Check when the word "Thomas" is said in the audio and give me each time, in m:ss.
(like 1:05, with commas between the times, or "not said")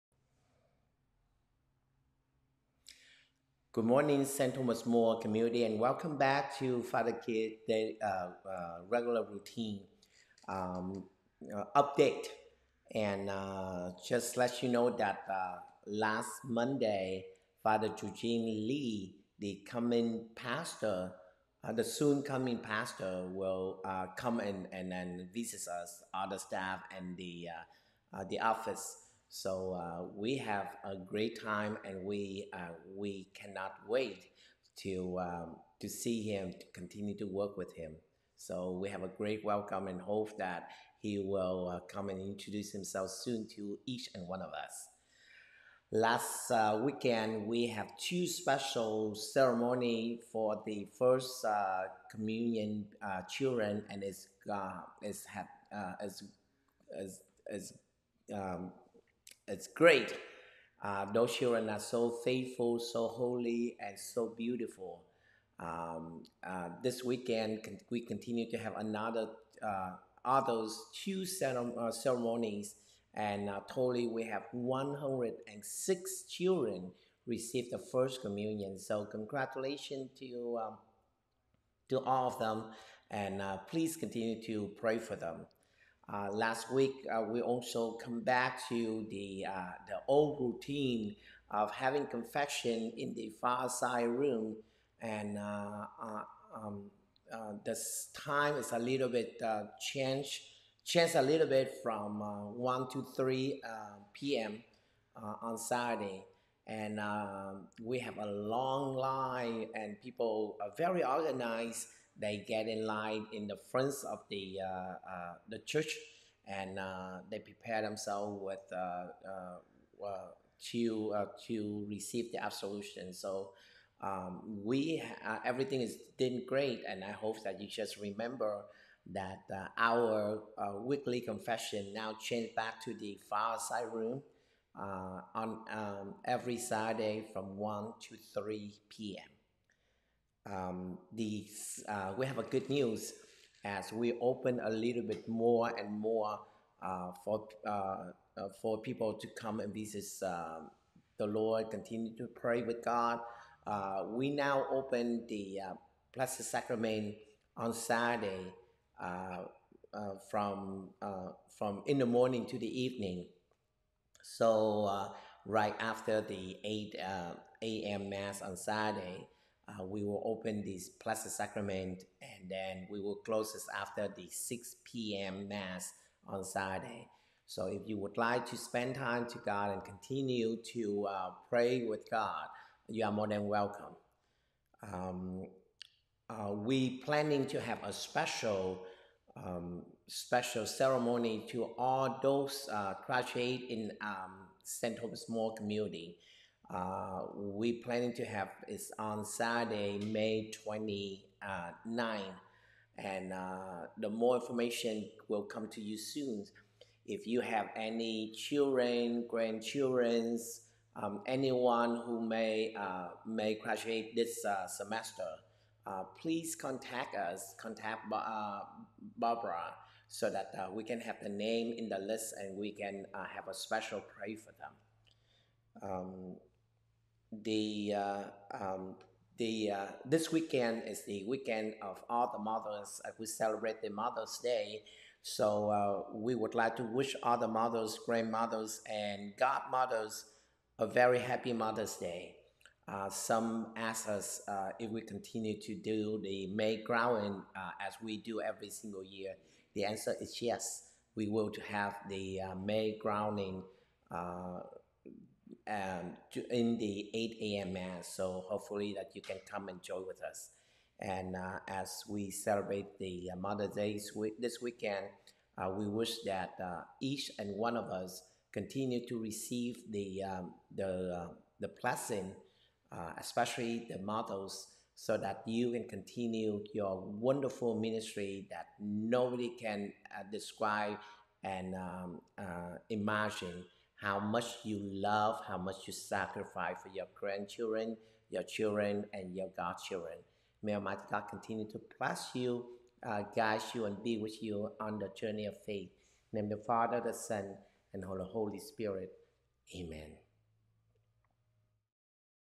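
0:04, 3:14.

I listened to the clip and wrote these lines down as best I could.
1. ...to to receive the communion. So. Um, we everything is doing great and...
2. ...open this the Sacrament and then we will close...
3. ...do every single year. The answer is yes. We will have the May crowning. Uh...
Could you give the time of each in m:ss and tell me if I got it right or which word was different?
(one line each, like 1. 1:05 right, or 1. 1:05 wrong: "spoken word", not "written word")
1. 2:00 wrong: "absolution", not "communion"
2. 2:50 right
3. 4:08 right.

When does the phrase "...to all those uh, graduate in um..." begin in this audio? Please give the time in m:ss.
3:11.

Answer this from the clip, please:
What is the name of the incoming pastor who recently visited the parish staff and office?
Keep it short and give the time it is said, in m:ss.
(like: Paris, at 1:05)
Father Eugene Lee, at 0:17.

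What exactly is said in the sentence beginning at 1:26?
Uh, last week, uh, we also come back to the, uh, the old routine of having confession in the fireside room.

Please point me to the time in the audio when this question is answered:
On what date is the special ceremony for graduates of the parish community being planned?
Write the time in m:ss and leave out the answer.
3:20.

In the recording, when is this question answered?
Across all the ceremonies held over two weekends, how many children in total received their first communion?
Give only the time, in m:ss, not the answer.
1:14.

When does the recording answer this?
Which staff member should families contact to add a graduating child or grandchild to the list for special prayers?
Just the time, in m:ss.
3:39.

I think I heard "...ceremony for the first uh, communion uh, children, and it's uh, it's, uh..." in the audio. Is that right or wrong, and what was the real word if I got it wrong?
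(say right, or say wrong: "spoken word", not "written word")
right.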